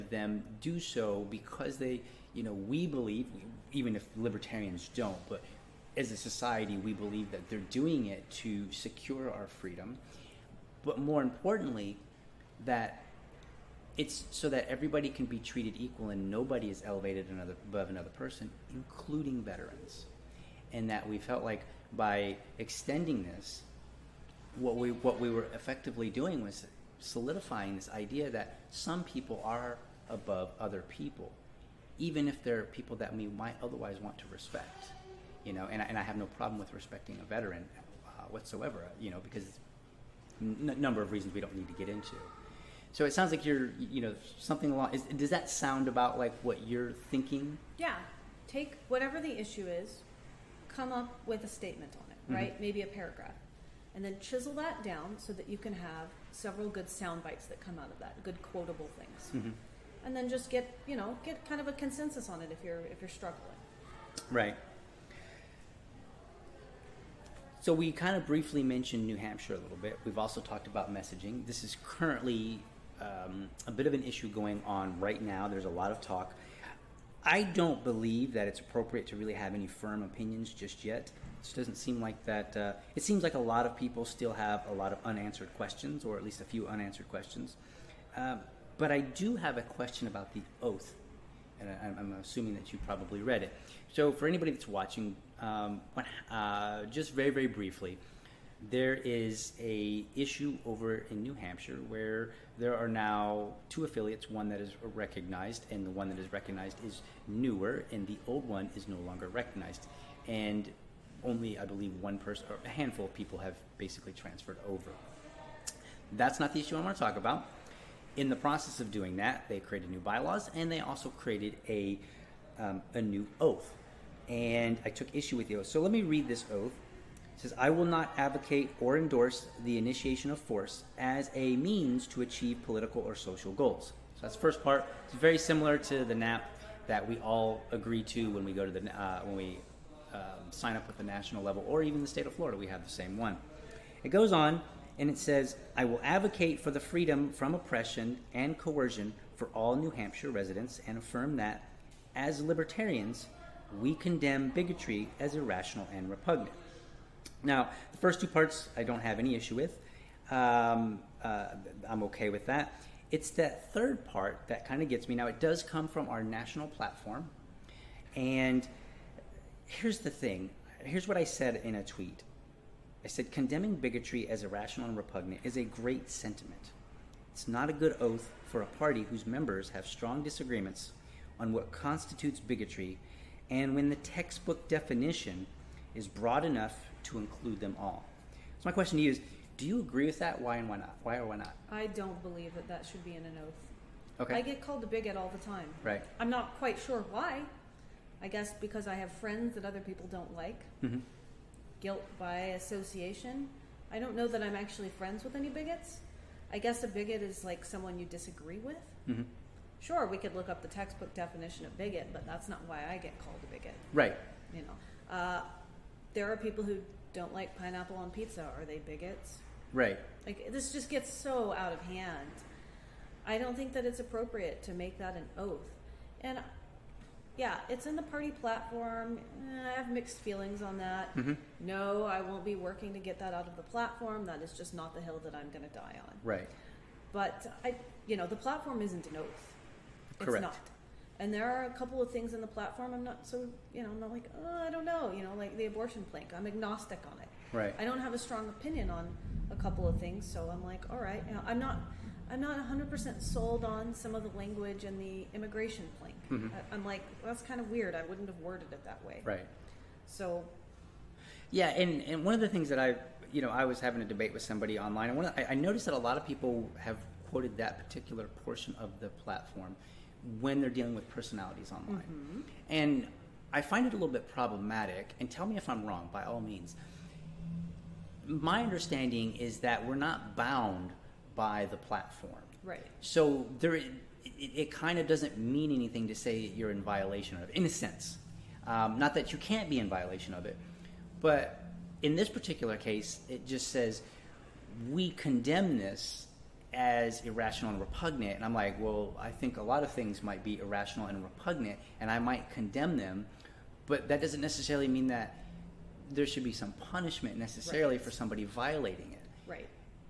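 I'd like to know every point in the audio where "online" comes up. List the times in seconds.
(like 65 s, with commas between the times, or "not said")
264 s, 271 s.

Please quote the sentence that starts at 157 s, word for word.
Now, the first two parts I don't have any issue with.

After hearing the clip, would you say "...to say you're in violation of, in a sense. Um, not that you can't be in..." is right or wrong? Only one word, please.
right.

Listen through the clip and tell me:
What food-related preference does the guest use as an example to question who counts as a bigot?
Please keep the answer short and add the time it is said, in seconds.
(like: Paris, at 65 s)
pineapple on pizza, at 217 s.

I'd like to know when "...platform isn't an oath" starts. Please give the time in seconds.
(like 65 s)
238 s.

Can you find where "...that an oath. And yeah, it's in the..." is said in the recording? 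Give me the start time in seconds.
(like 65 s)
224 s.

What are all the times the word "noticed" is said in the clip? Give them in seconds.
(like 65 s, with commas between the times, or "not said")
265 s.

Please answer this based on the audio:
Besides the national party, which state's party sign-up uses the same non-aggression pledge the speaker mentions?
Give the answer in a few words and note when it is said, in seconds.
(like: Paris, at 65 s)
Florida, at 142 s.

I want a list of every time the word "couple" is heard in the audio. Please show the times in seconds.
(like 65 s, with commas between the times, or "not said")
241 s, 249 s.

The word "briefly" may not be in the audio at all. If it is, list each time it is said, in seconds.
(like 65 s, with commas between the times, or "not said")
68 s, 97 s.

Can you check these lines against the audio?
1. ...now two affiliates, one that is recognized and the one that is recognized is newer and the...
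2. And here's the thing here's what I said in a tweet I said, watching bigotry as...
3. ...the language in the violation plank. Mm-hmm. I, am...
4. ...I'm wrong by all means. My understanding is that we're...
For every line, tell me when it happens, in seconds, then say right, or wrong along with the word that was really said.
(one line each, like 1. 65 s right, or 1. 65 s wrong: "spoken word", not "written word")
1. 102 s right
2. 168 s wrong: "condemning", not "watching"
3. 254 s wrong: "immigration", not "violation"
4. 275 s right.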